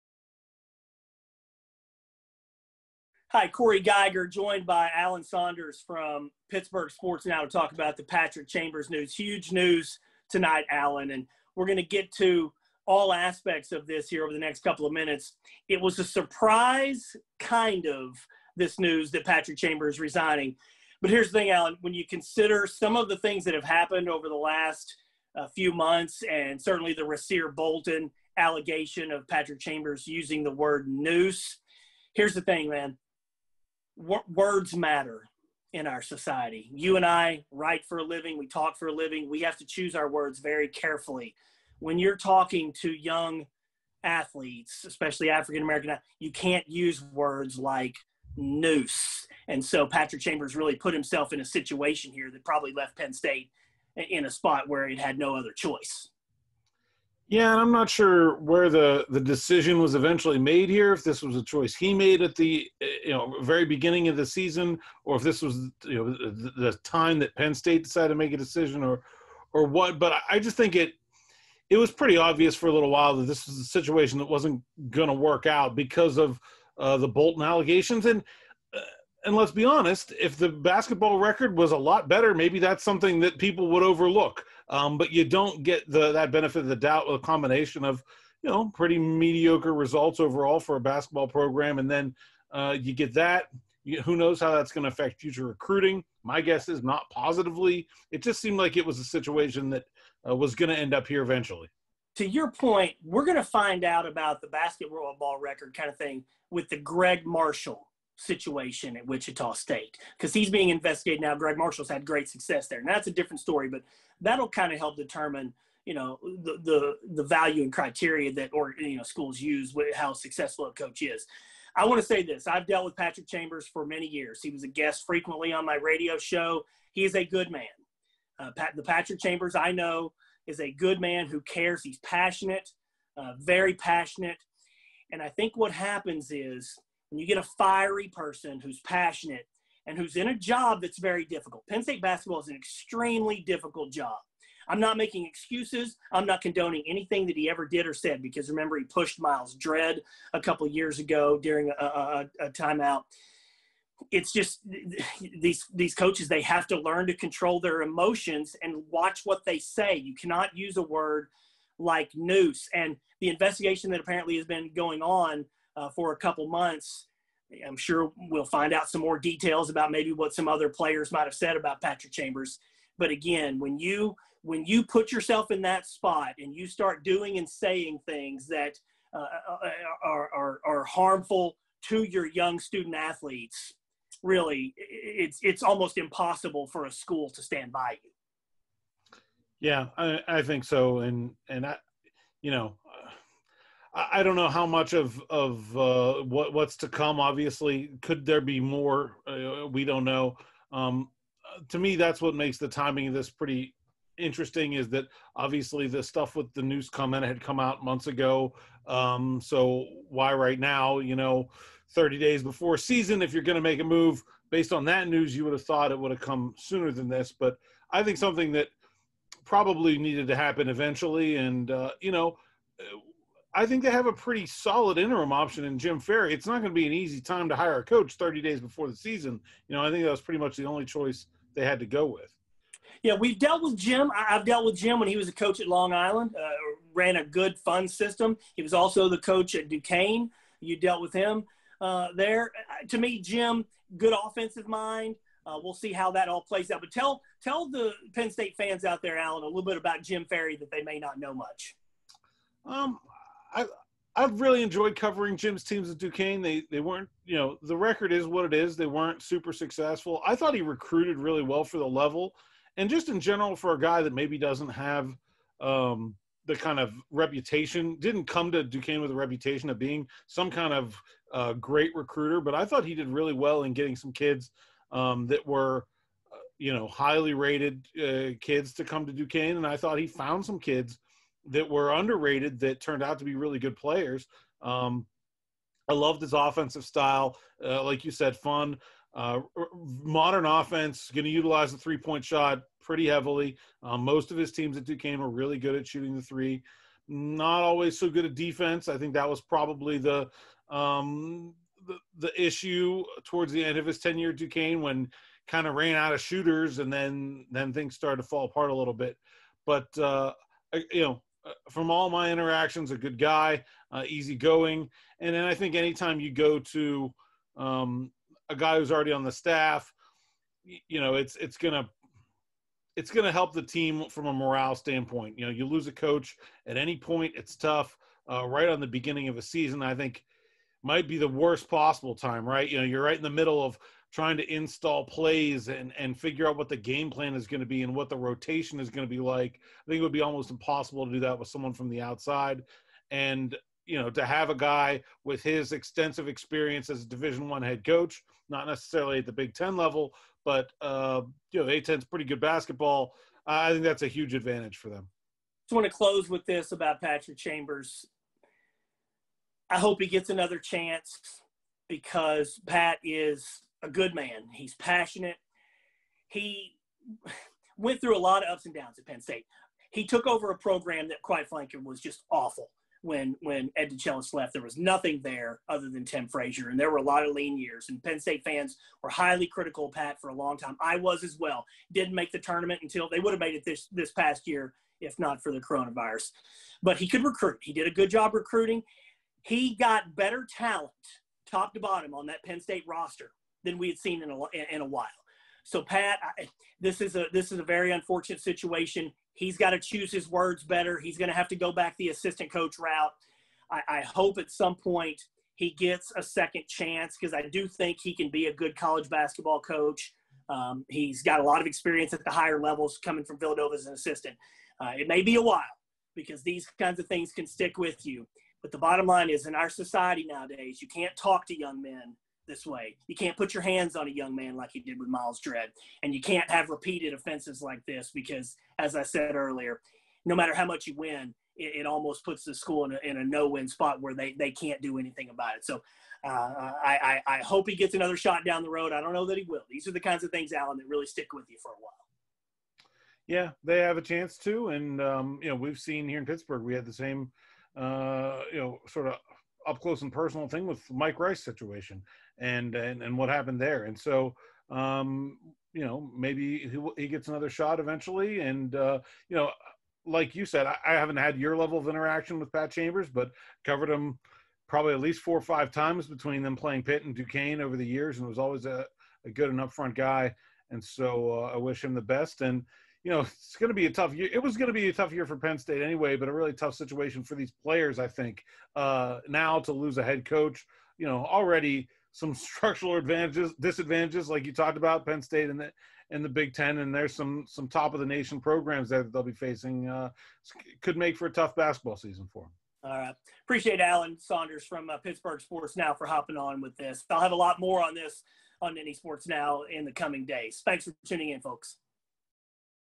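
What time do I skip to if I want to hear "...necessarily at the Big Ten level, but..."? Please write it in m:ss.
5:48.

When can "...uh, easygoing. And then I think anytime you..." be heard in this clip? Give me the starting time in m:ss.
5:13.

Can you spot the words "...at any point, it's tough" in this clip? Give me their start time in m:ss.
5:26.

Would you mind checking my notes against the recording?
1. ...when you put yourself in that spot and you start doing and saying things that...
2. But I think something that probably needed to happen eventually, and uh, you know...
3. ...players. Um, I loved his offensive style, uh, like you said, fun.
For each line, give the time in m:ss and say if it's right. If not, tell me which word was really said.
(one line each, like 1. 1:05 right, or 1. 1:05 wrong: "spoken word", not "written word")
1. 2:54 right
2. 3:37 right
3. 4:43 right.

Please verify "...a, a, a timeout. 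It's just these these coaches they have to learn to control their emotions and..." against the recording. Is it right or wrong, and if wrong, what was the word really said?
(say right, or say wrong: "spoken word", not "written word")
right.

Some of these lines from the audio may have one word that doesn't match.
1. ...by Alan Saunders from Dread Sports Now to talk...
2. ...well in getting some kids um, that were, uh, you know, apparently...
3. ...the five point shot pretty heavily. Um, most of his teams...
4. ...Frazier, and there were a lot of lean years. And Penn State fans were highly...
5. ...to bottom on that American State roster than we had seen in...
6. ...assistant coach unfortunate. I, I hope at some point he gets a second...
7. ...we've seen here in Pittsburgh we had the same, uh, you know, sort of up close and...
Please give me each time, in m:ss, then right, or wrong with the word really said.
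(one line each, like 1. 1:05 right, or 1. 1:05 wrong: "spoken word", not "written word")
1. 0:04 wrong: "Pittsburgh", not "Dread"
2. 4:33 wrong: "highly", not "apparently"
3. 4:51 wrong: "three", not "five"
4. 6:16 right
5. 6:31 wrong: "Penn", not "American"
6. 6:42 wrong: "route", not "unfortunate"
7. 7:25 right.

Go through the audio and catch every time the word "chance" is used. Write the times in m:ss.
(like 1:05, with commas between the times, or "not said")
6:00, 6:46, 7:24.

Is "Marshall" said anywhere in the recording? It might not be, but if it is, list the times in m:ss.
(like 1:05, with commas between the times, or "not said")
1:47, 1:51.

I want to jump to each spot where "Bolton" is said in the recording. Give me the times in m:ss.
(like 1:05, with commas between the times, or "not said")
0:27, 1:17.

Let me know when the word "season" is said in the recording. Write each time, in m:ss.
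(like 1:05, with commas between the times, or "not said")
1:04, 3:32, 3:48, 5:29, 8:11.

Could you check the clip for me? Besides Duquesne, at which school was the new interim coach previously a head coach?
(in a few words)
Long Island.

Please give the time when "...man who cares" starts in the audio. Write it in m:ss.
2:11.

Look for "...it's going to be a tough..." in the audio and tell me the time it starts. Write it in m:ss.
7:53.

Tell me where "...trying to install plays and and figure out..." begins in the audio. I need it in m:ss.
5:34.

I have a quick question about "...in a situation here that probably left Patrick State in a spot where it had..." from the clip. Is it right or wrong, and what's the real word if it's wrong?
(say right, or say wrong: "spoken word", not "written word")
wrong: "Penn", not "Patrick".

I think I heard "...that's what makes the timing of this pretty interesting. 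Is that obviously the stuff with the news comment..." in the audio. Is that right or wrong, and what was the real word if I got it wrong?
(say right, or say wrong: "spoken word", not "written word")
right.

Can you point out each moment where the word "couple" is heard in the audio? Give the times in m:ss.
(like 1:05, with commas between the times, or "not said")
0:14, 2:30, 2:46.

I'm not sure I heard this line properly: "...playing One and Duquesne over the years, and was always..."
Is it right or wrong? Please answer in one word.
wrong.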